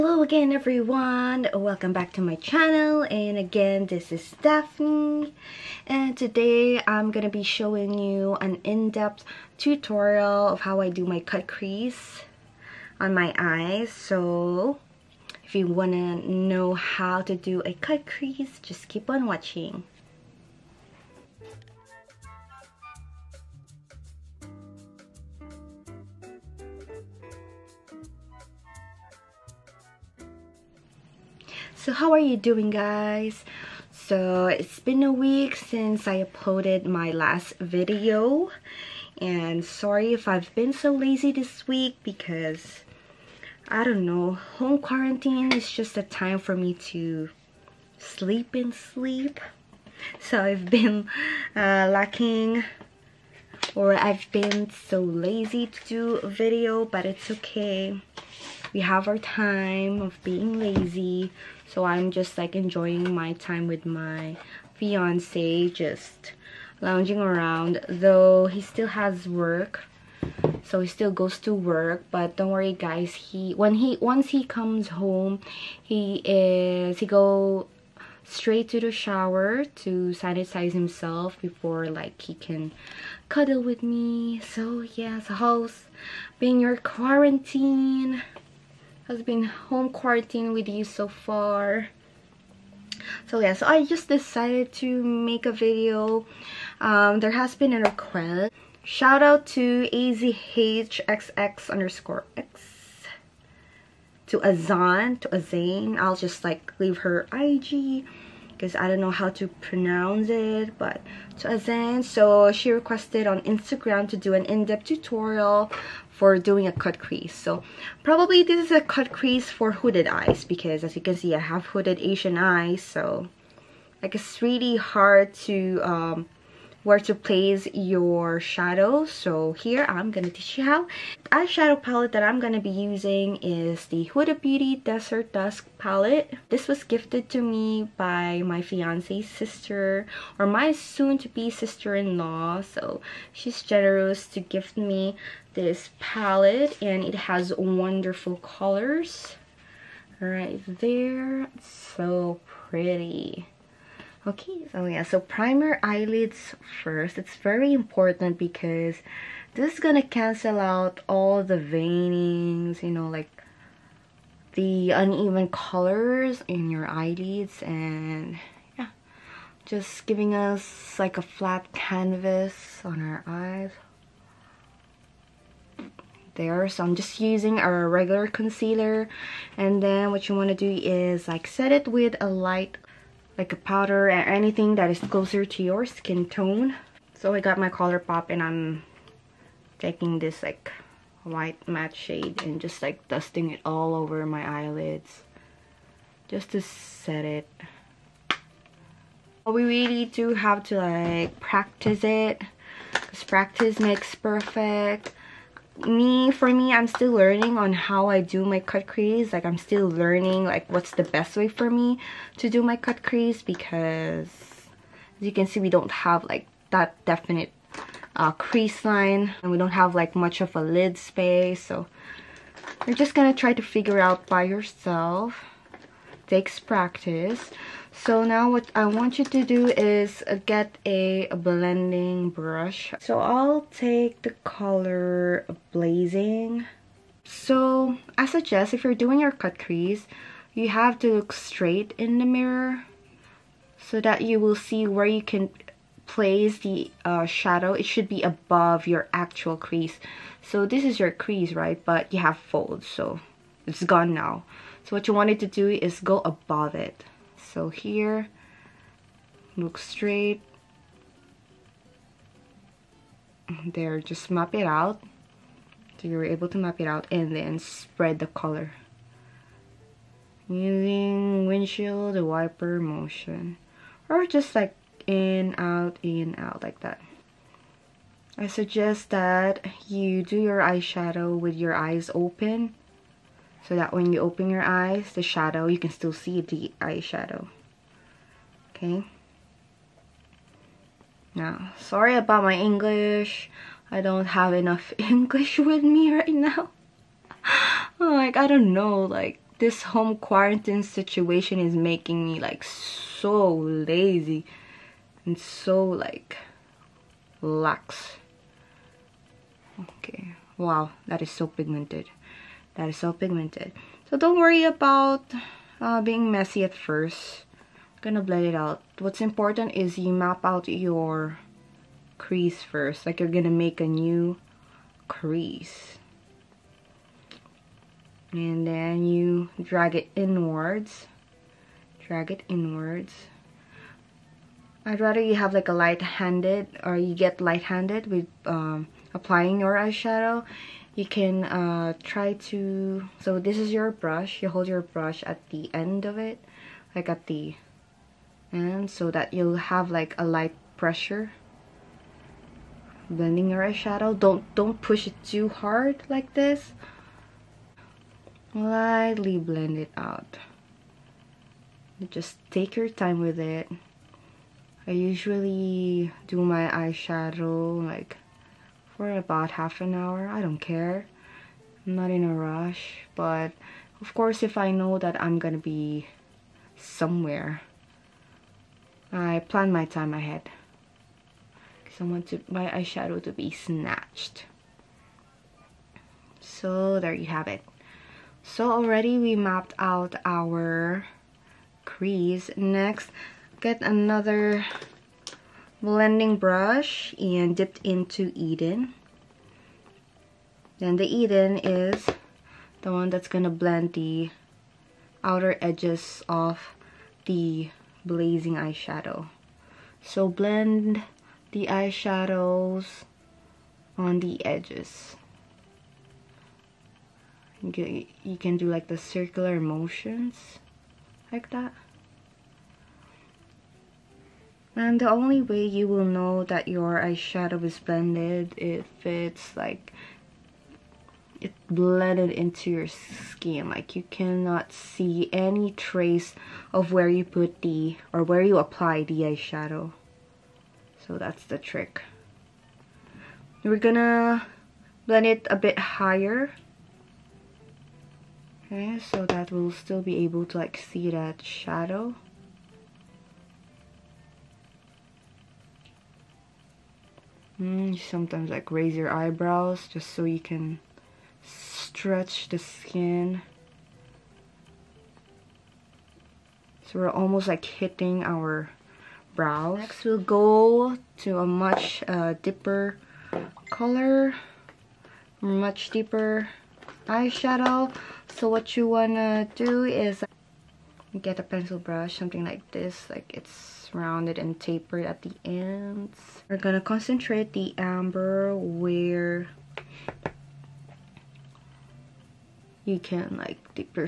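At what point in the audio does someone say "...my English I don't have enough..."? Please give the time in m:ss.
4:52.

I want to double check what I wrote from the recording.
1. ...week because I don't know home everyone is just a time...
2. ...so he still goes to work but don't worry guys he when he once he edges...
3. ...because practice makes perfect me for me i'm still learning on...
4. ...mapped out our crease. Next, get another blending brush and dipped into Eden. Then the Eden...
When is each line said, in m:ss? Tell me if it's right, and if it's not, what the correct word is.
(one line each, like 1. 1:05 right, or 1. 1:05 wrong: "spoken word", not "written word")
1. 0:41 wrong: "quarantine", not "everyone"
2. 1:10 wrong: "comes", not "edges"
3. 3:22 right
4. 6:29 right.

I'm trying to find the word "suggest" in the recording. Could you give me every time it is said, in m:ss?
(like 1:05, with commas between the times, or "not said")
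3:58, 4:38.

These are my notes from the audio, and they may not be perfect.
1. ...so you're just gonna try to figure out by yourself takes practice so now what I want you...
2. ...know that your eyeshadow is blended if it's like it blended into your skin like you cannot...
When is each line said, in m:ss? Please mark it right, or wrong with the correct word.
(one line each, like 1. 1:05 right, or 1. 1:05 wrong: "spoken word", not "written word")
1. 3:41 right
2. 7:06 right.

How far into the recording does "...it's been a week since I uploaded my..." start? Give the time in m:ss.
0:34.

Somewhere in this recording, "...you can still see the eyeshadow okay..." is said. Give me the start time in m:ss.
4:45.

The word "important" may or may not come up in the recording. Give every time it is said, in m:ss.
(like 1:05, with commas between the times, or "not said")
2:37, 5:19.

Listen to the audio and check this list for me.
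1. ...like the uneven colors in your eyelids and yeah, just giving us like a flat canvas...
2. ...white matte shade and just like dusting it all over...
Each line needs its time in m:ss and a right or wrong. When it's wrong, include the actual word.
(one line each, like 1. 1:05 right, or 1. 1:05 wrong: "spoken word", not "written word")
1. 2:43 right
2. 3:11 right.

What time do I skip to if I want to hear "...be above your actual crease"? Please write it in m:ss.
4:08.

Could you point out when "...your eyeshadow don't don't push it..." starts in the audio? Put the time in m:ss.
5:53.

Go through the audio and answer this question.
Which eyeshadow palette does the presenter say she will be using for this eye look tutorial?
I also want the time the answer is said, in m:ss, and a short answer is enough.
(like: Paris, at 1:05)
Huda Beauty Desert Dusk, at 2:14.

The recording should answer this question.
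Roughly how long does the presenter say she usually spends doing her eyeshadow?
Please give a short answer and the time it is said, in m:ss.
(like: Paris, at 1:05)
Half an hour, at 6:09.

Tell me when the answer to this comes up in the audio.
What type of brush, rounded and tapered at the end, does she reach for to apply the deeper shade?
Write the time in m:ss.
8:01.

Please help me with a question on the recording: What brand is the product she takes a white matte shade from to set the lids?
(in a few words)
Color Pop.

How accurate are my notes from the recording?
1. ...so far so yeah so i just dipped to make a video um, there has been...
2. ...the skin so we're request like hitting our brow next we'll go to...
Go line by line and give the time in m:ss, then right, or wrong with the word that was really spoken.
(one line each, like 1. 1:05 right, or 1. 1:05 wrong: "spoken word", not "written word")
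1. 1:30 wrong: "decided", not "dipped"
2. 7:42 wrong: "almost", not "request".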